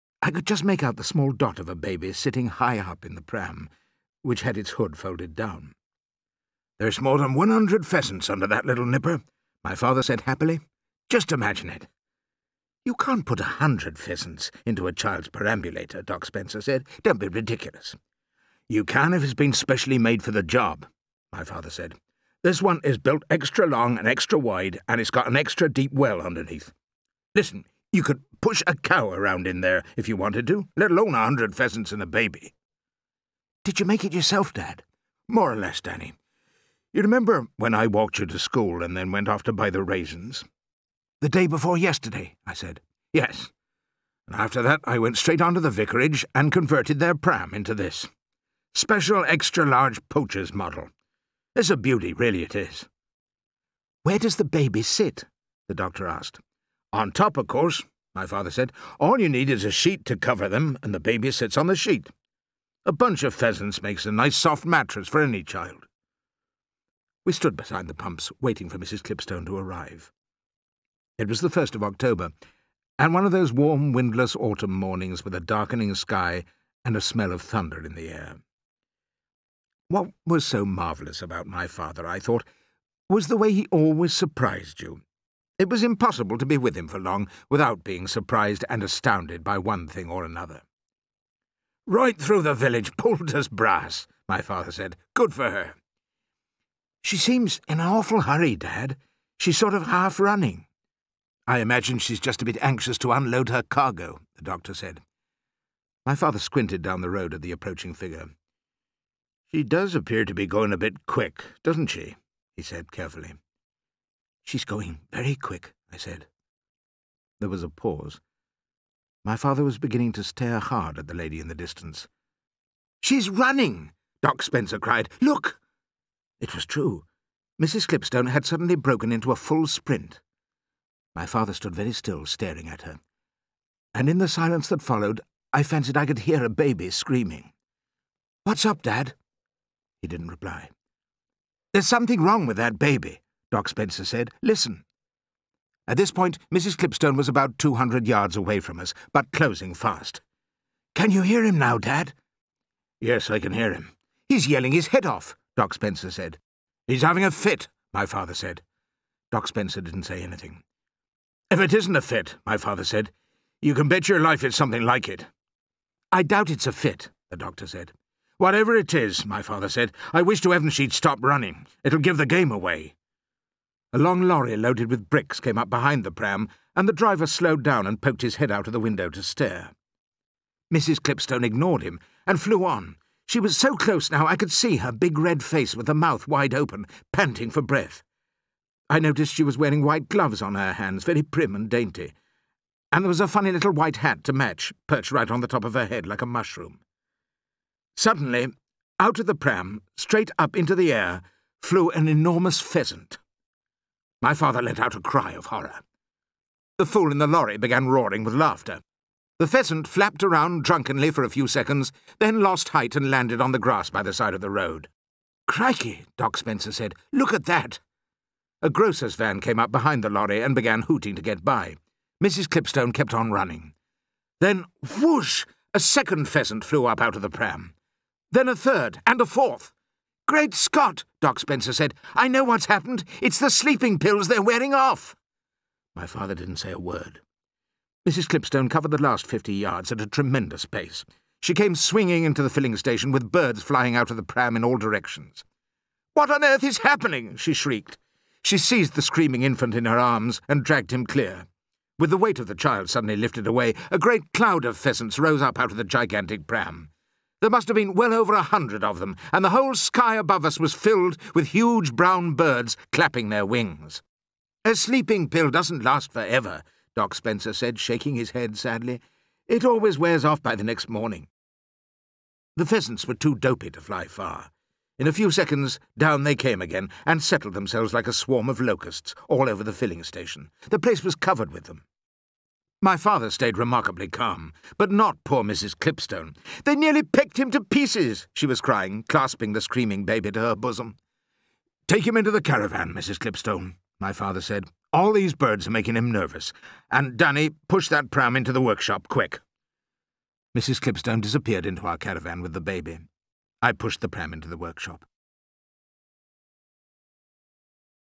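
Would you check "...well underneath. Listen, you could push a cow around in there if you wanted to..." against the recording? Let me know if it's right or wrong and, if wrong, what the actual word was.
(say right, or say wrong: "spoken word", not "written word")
right.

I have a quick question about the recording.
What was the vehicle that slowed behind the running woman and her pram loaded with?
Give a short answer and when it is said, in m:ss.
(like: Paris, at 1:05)
bricks, at 2:55.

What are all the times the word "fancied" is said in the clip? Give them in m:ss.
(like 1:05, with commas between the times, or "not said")
2:15.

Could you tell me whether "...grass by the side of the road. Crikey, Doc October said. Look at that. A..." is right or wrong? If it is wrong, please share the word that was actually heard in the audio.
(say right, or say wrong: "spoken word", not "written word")
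wrong: "Spencer", not "October".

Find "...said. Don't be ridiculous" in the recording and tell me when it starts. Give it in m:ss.
0:16.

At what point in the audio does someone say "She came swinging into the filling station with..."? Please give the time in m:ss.
4:01.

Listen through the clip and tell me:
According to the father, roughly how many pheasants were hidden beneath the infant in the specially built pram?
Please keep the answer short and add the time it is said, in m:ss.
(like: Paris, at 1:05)
more than 100, at 0:07.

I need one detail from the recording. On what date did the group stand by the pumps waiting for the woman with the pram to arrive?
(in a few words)
1st of October.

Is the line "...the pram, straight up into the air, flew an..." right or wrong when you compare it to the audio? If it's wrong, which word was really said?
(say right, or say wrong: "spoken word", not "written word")
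right.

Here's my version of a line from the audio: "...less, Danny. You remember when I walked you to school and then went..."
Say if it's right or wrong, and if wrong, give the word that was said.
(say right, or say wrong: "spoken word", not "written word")
right.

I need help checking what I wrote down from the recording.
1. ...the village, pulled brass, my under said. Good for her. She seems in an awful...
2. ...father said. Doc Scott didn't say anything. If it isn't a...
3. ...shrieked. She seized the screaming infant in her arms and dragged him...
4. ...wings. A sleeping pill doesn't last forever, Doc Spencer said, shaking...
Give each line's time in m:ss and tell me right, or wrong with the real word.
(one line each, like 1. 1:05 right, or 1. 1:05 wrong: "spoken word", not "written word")
1. 1:32 wrong: "father", not "under"
2. 2:38 wrong: "Spencer", not "Scott"
3. 4:07 right
4. 4:23 right.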